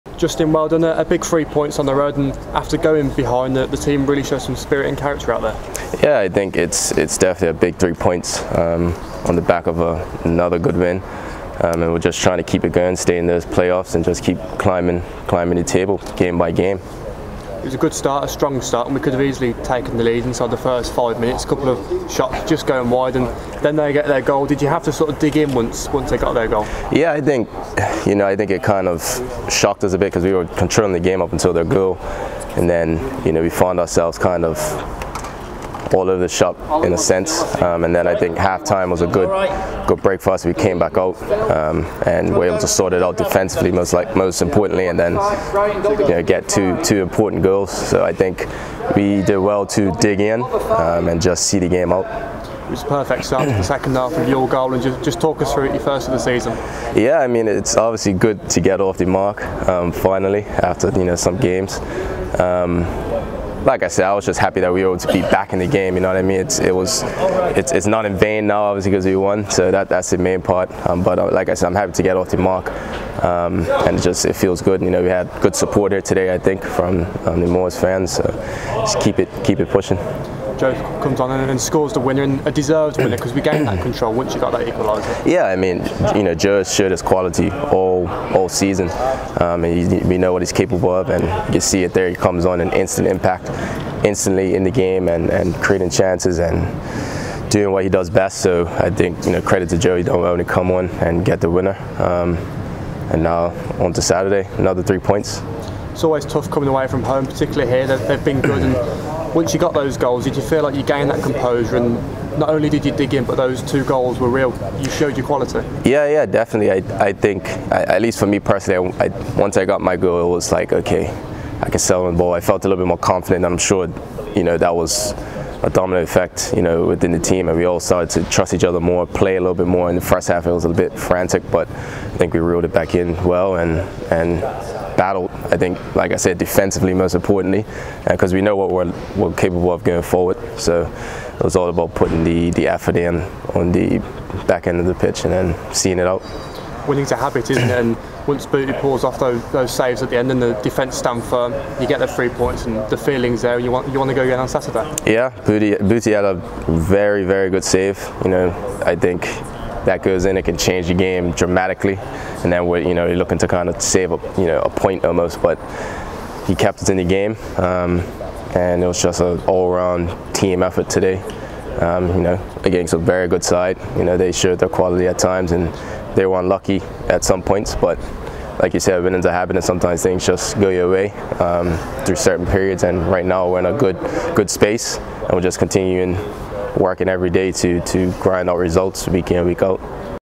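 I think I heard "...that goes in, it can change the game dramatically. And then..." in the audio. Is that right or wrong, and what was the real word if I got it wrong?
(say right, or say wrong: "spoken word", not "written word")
right.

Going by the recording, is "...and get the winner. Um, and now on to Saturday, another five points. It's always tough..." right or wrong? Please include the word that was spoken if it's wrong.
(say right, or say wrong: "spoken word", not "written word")
wrong: "three", not "five".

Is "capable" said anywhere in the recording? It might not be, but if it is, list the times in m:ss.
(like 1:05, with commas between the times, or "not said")
1:30, 2:19.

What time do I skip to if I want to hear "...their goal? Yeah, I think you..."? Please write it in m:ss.
0:26.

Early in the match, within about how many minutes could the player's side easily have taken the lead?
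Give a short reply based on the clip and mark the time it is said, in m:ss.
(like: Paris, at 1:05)
5, at 0:20.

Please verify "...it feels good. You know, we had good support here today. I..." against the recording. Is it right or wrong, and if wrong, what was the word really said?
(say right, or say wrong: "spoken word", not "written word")
right.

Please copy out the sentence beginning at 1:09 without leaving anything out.
So that that's the main part.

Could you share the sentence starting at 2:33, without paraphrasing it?
You want you want to go again on Saturday.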